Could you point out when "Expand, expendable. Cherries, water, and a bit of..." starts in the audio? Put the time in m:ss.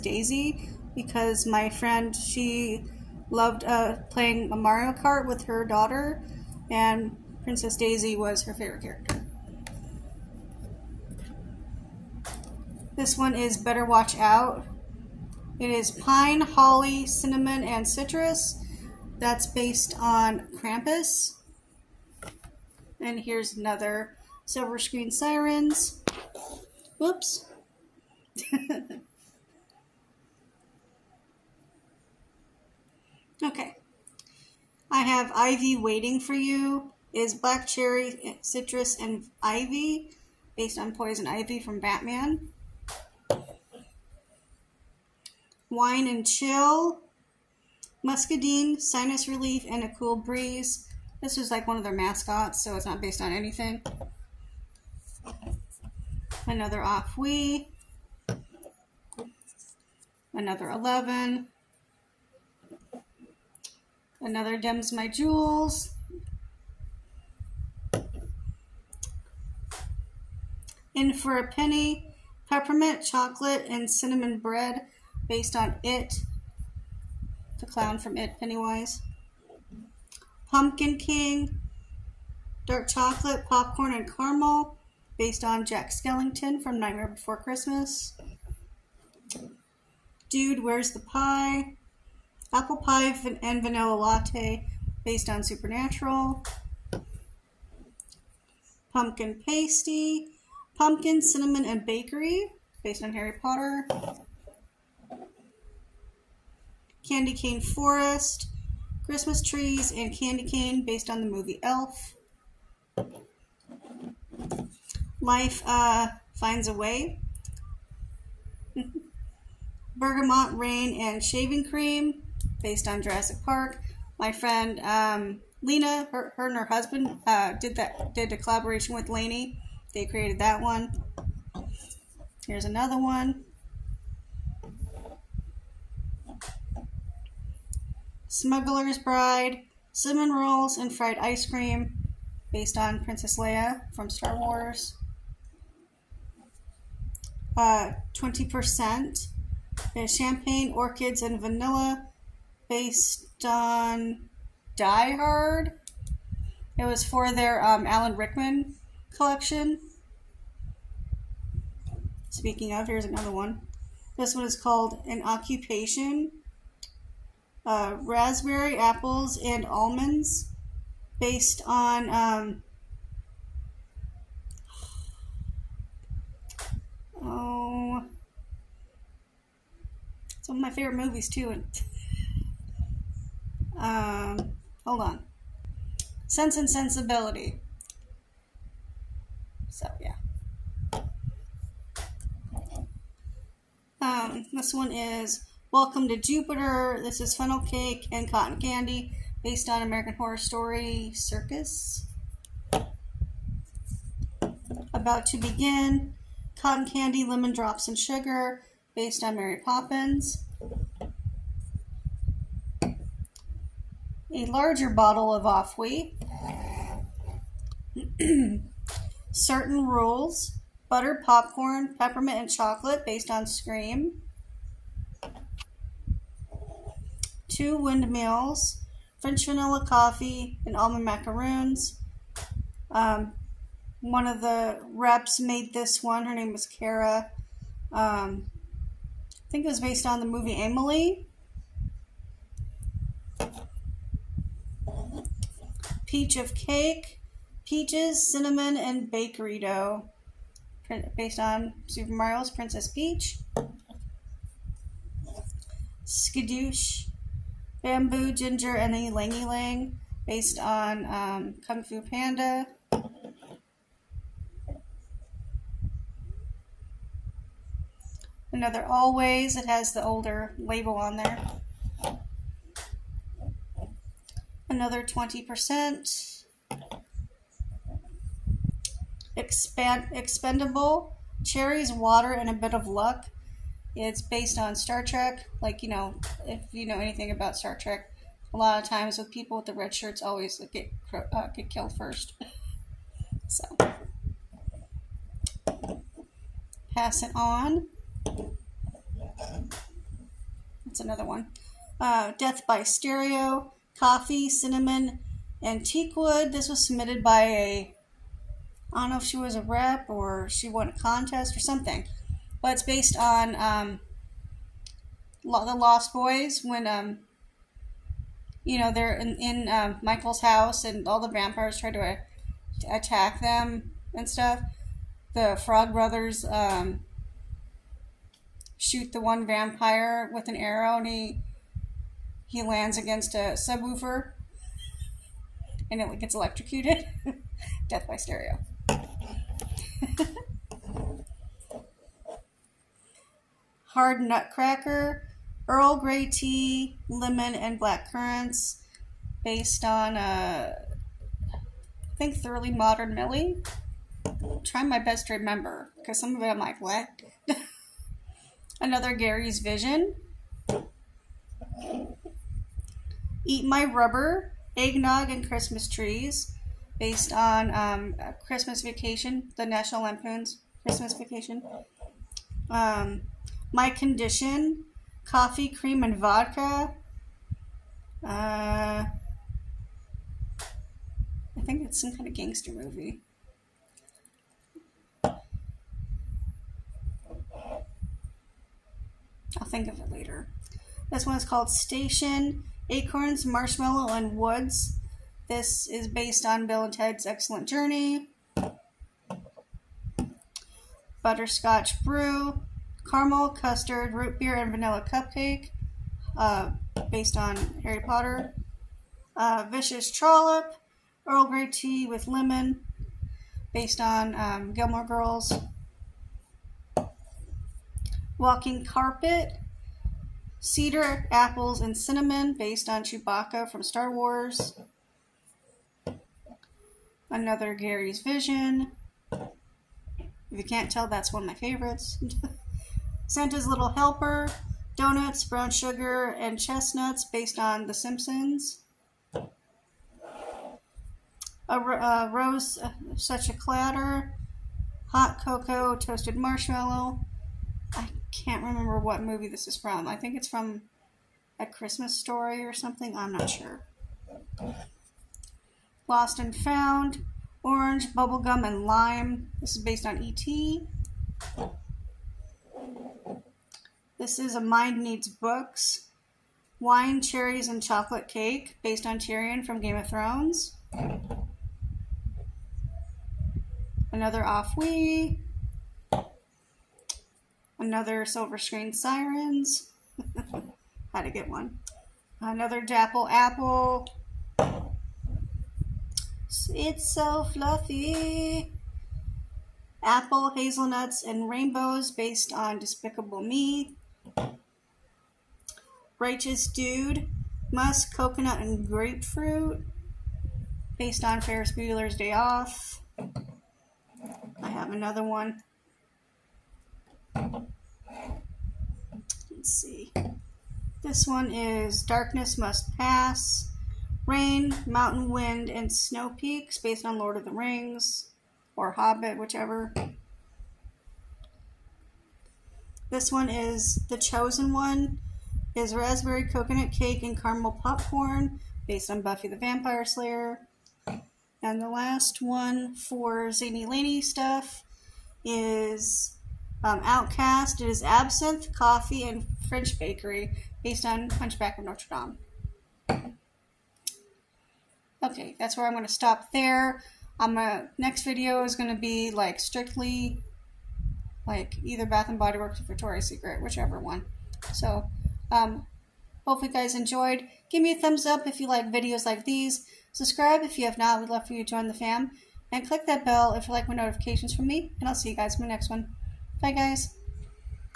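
4:39.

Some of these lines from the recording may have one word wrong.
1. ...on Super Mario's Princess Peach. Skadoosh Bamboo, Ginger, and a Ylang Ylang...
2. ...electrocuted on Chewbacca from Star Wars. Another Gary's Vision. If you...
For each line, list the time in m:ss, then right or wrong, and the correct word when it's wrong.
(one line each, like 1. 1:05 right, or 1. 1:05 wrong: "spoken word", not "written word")
1. 4:11 right
2. 7:02 wrong: "based", not "electrocuted".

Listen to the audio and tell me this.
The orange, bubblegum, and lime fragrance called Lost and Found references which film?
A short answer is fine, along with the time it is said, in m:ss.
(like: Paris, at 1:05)
E.T., at 7:40.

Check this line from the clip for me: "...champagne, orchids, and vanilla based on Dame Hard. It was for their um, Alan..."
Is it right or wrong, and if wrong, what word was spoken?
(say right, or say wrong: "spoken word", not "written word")
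wrong: "Die", not "Dame".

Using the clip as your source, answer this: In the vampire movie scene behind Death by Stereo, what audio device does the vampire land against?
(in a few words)
A subwoofer.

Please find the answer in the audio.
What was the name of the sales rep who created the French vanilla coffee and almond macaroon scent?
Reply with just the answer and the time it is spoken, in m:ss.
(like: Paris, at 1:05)
Kara, at 3:56.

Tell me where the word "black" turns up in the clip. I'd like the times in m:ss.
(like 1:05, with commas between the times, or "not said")
0:37, 5:47.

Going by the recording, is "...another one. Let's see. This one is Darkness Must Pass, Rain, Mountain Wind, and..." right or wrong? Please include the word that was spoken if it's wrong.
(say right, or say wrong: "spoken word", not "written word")
right.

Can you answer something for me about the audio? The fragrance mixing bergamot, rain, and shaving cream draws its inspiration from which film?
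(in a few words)
Jurassic Park.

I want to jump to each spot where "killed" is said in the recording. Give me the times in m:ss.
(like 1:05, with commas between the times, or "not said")
4:51.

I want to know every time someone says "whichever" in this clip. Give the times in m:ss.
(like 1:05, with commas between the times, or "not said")
8:39, 9:13.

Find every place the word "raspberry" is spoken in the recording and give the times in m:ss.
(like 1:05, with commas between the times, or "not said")
2:48, 8:45.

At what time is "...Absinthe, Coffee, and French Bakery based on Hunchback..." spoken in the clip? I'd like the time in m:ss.
8:58.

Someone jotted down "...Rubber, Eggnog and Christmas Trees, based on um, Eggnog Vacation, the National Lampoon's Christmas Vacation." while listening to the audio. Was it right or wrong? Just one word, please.
wrong.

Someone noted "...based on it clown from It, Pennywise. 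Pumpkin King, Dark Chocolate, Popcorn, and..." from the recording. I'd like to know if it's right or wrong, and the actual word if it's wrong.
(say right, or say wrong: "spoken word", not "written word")
right.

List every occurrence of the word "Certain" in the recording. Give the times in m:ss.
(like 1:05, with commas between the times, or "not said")
3:39.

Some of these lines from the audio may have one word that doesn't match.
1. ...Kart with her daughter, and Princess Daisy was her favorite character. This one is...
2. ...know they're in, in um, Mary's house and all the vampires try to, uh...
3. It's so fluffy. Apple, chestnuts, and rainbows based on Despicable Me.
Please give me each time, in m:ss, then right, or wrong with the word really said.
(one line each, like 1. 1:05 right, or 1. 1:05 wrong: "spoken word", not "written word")
1. 0:04 right
2. 5:18 wrong: "Michael", not "Mary"
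3. 8:06 wrong: "hazelnuts", not "chestnuts".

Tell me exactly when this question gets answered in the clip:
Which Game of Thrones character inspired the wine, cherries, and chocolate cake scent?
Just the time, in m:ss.
7:49.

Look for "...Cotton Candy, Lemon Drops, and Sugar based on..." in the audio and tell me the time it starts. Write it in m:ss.
3:26.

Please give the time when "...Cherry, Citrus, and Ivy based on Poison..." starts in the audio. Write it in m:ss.
0:37.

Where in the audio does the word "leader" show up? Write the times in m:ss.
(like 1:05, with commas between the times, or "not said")
not said.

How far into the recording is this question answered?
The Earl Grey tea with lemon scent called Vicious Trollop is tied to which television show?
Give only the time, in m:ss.
6:54.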